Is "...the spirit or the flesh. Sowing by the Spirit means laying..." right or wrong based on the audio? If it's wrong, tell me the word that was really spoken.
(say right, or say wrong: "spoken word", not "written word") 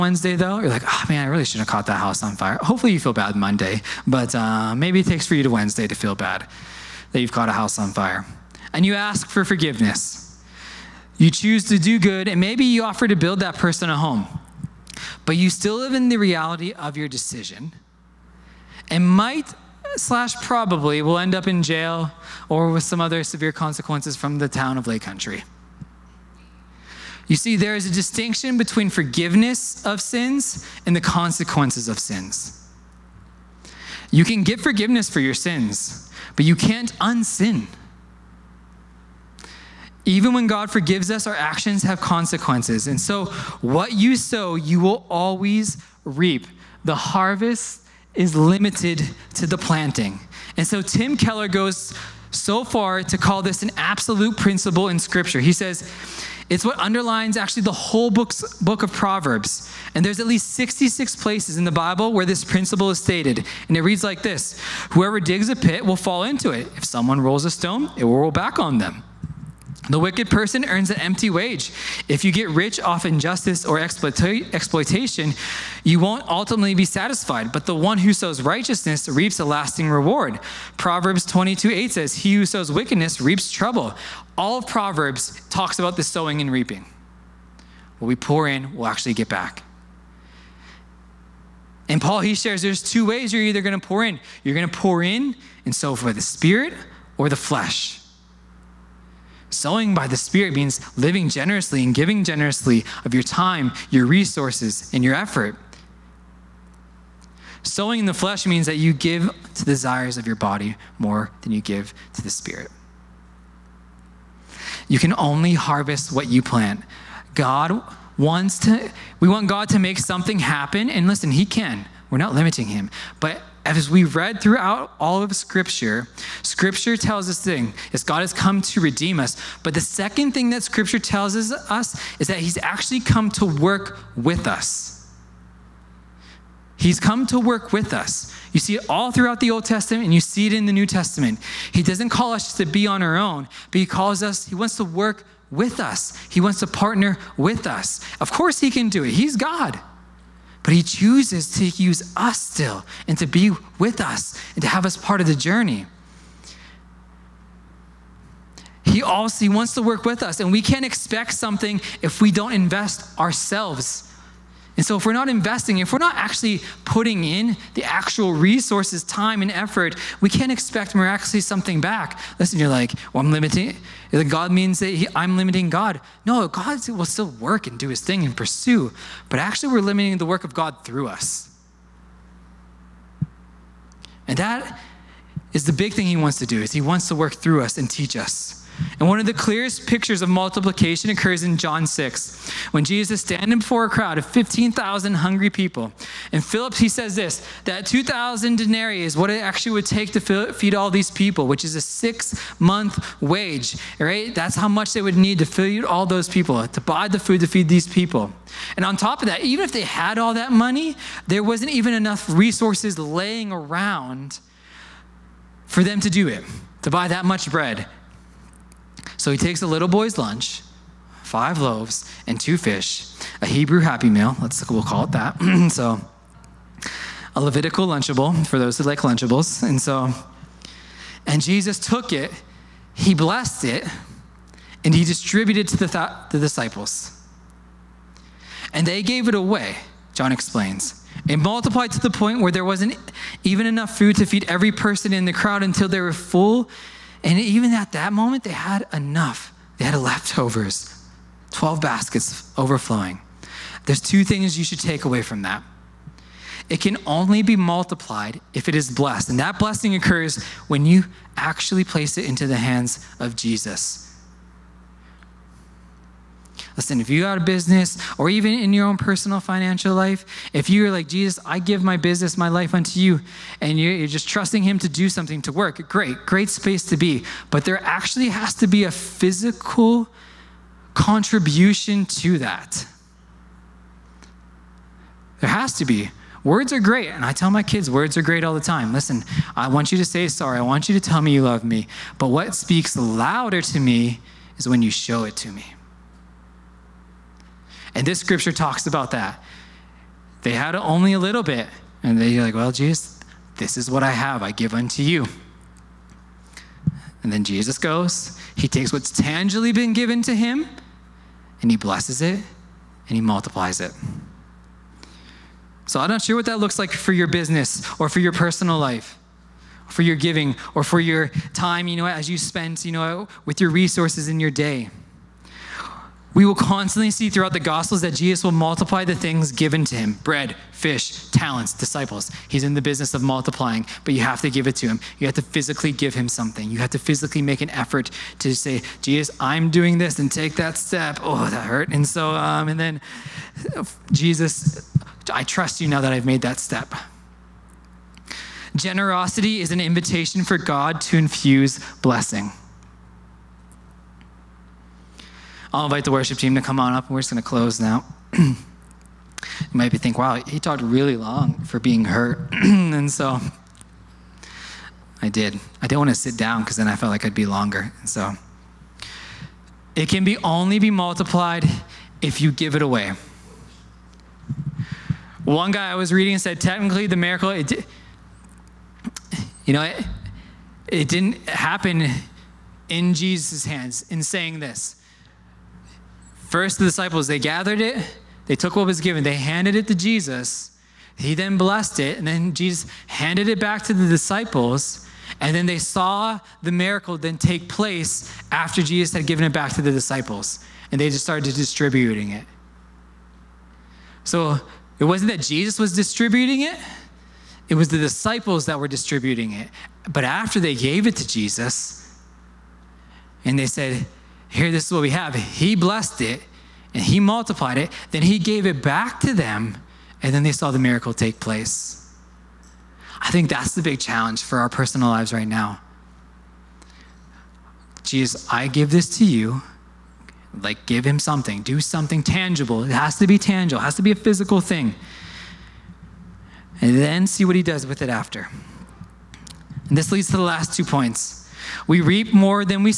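wrong: "living", not "laying".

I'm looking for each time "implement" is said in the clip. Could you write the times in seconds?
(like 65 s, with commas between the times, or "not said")
not said.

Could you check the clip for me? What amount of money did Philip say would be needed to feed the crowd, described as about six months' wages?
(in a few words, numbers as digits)
2,000 denarii.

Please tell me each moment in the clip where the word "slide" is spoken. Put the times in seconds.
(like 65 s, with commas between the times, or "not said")
not said.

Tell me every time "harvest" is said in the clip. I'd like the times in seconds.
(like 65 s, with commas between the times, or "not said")
46 s, 115 s.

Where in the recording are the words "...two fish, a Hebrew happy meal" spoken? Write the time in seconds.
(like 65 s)
222 s.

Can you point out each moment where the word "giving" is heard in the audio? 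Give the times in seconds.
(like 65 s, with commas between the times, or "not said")
101 s, 320 s.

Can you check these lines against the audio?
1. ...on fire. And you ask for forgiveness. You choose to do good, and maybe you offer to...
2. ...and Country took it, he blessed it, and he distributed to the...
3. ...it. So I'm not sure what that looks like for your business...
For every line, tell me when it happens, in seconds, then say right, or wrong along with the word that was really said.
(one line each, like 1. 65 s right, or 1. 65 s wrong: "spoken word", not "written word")
1. 7 s right
2. 231 s wrong: "Jesus", not "Country"
3. 313 s right.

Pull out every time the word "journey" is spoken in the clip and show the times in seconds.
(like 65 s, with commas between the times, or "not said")
155 s.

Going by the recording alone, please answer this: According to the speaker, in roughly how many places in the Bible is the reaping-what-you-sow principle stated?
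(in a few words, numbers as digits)
66.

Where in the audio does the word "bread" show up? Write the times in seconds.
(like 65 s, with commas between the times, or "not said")
217 s, 330 s.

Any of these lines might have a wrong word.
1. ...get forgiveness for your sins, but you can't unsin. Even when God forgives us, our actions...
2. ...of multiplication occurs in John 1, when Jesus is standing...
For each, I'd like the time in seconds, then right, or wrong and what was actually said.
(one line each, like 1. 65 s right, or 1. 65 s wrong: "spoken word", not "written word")
1. 34 s right
2. 190 s wrong: "6", not "1".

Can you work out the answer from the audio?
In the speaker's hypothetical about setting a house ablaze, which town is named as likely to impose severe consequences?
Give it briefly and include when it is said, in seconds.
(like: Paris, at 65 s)
Lake Country, at 24 s.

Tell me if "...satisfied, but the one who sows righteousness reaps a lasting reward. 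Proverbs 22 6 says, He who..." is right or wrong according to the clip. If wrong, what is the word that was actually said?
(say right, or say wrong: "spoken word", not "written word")
wrong: "8", not "6".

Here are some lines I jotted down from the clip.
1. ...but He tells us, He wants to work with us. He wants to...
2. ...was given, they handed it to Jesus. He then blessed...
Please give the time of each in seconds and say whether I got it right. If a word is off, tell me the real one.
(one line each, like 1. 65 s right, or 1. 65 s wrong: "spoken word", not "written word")
1. 143 s wrong: "calls", not "tells"
2. 388 s right.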